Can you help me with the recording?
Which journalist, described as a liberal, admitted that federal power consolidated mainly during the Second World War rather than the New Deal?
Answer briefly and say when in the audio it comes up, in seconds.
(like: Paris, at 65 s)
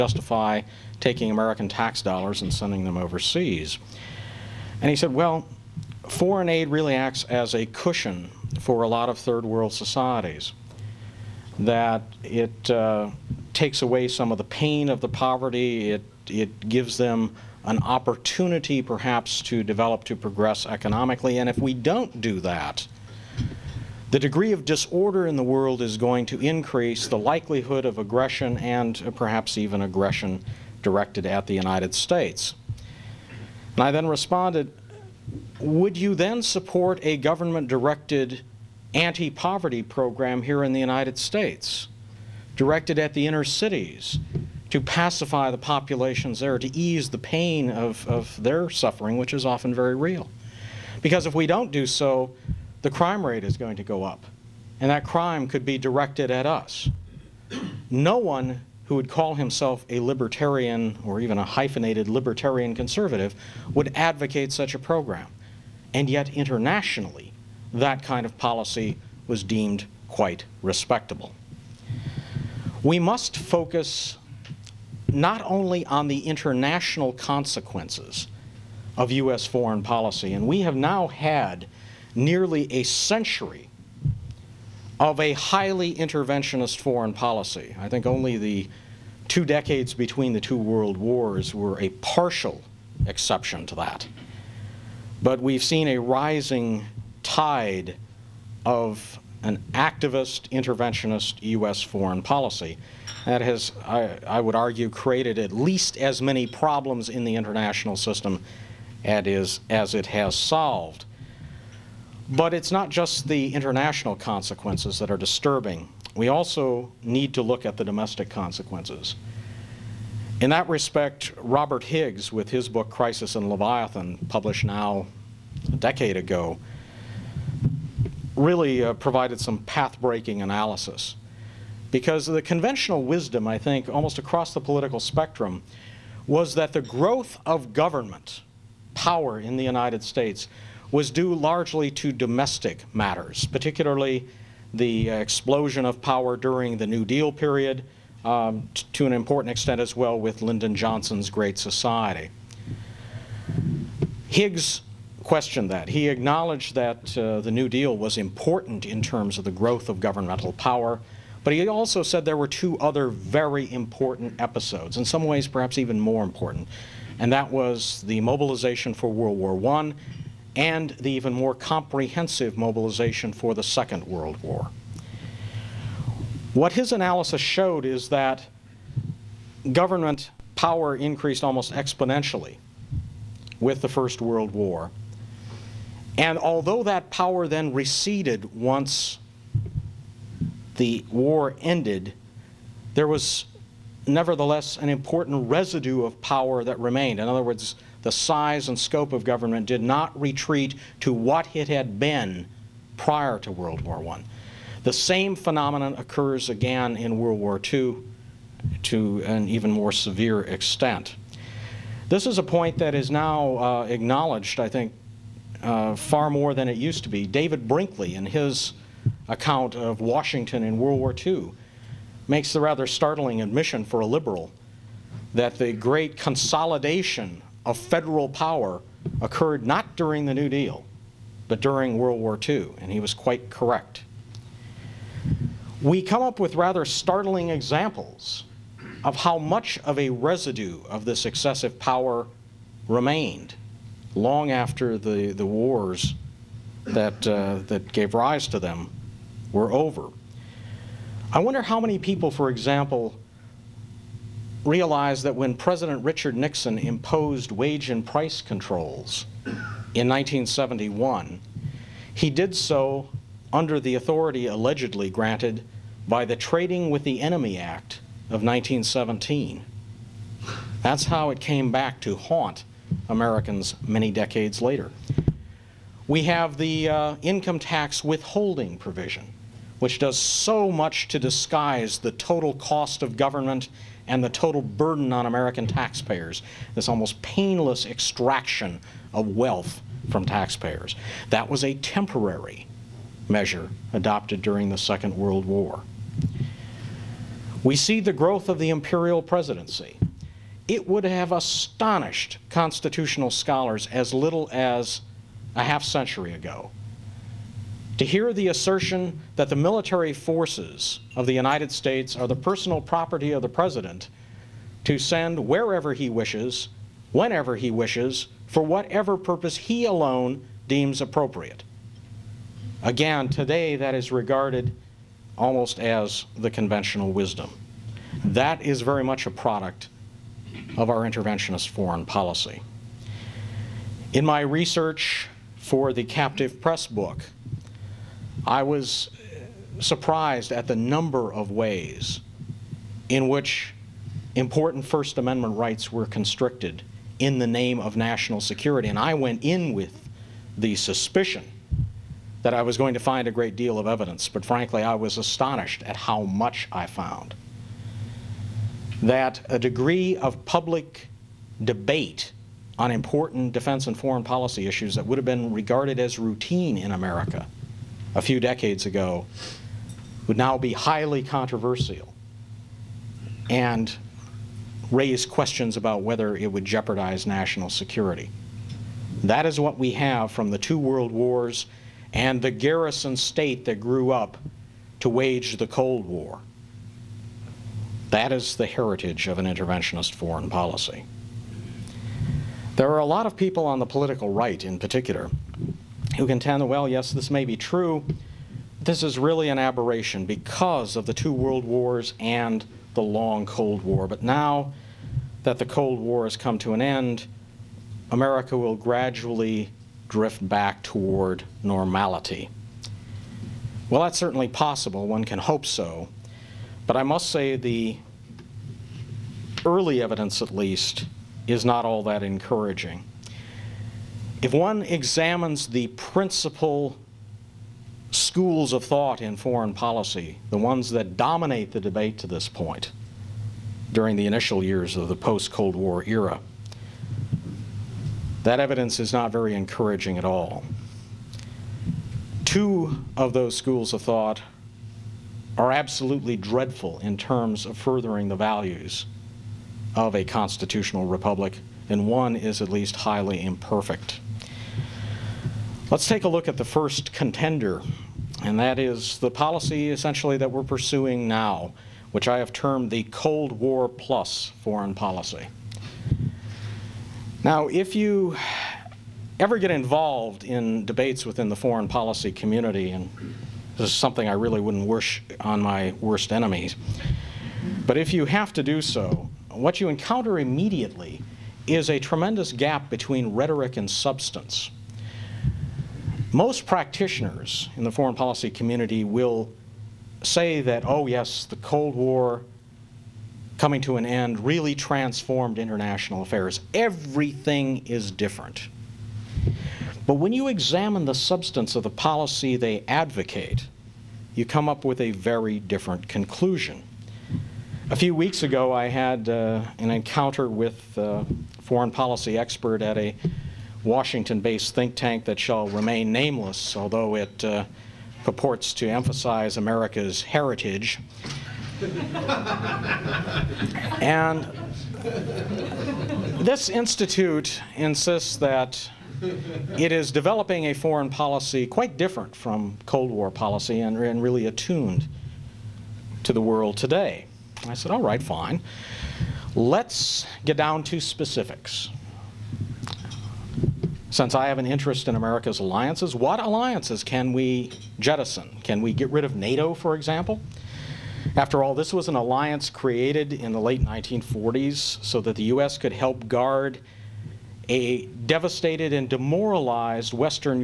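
David Brinkley, at 217 s.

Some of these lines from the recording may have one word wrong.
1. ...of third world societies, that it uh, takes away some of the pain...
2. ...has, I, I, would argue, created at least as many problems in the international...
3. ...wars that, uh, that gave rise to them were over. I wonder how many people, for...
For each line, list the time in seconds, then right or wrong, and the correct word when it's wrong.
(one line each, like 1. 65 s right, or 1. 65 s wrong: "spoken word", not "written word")
1. 9 s right
2. 103 s right
3. 245 s right.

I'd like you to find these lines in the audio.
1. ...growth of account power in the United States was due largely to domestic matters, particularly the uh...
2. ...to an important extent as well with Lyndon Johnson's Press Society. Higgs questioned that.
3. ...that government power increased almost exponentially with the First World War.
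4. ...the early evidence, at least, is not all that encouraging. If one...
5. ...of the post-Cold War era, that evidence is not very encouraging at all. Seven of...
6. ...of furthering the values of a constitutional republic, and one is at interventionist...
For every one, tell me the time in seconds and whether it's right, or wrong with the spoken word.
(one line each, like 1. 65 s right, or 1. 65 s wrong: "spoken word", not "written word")
1. 136 s wrong: "government", not "account"
2. 148 s wrong: "Great", not "Press"
3. 178 s right
4. 417 s right
5. 434 s wrong: "Two", not "Seven"
6. 447 s wrong: "least", not "interventionist".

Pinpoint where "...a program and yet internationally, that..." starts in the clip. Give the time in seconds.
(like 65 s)
64 s.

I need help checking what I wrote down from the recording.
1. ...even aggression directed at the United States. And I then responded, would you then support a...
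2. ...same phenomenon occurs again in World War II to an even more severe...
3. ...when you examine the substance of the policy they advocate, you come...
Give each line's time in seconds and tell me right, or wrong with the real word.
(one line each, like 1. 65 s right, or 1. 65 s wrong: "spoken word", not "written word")
1. 29 s right
2. 204 s right
3. 500 s right.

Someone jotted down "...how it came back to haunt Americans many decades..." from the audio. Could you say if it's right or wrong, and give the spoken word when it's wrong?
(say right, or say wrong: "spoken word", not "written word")
right.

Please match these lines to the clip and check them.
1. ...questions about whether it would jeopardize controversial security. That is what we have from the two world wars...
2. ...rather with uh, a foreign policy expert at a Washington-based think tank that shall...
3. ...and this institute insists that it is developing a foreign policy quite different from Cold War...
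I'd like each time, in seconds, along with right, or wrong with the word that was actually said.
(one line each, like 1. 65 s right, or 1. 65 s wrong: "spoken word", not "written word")
1. 375 s wrong: "national", not "controversial"
2. 509 s wrong: "encounter", not "rather"
3. 524 s right.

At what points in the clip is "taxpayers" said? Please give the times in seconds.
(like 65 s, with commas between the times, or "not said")
285 s, 290 s.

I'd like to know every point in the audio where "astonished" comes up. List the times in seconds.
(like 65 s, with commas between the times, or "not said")
301 s, 355 s.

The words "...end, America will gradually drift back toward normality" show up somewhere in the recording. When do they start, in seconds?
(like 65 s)
406 s.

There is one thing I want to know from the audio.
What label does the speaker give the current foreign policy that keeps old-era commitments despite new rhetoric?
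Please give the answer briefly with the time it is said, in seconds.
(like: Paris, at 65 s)
Cold War plus, at 463 s.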